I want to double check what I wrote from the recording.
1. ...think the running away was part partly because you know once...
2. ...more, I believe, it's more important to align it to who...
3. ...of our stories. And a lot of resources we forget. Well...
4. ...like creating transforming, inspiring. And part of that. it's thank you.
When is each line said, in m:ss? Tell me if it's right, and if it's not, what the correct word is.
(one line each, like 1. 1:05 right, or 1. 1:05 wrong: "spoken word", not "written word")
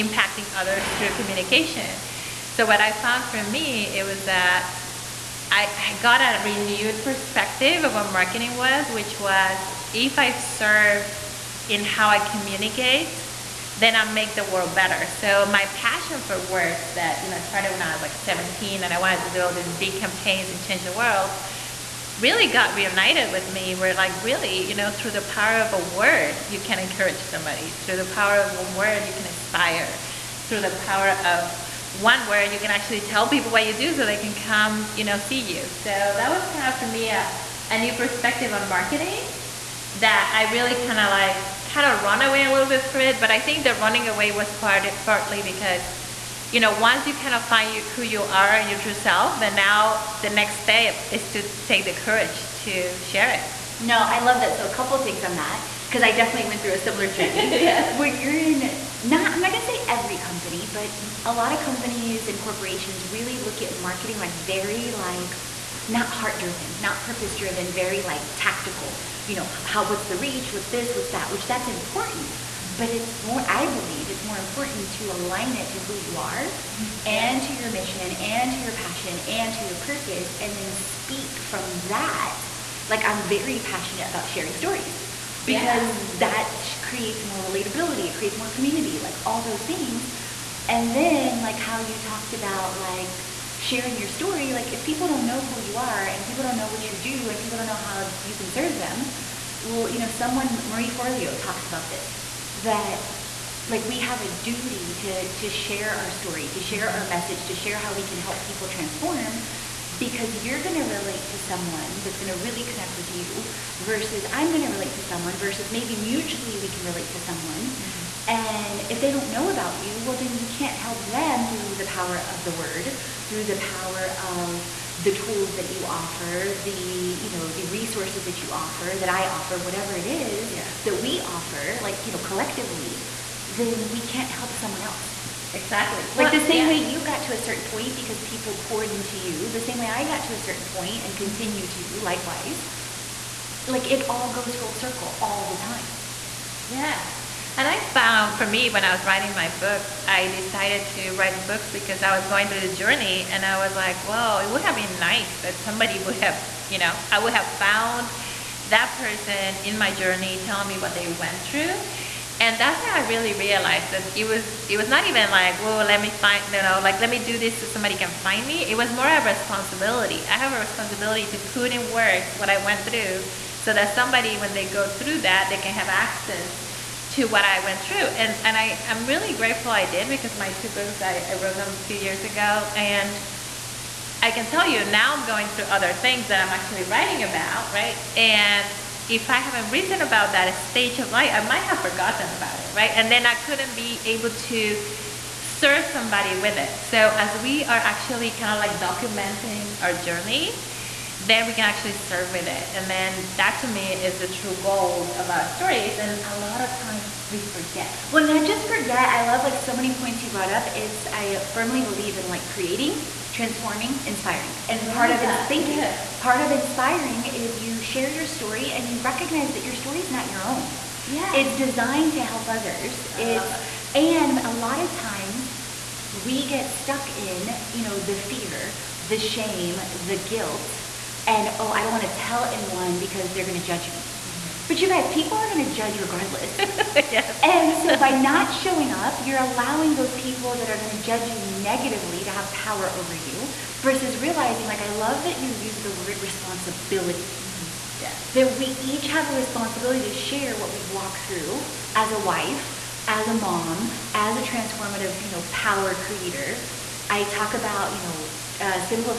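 1. 0:43 right
2. 1:13 right
3. 3:25 wrong: "times", not "resources"
4. 3:32 right.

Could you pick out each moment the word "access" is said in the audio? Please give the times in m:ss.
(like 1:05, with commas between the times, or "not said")
2:55.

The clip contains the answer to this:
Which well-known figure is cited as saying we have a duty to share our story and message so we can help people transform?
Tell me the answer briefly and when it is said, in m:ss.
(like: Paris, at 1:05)
Marie Forleo, at 1:40.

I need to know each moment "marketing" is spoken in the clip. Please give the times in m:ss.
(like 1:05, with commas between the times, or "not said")
0:08, 0:38, 1:03.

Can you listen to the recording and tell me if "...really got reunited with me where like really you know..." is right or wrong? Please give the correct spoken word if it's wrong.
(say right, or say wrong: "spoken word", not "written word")
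right.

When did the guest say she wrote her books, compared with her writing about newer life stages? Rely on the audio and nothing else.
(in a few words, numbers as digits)
a few years ago.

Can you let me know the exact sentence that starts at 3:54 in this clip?
But you guys, people are gonna judge regardless.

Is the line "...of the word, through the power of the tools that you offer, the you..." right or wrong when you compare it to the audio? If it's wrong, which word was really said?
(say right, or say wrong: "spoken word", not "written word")
right.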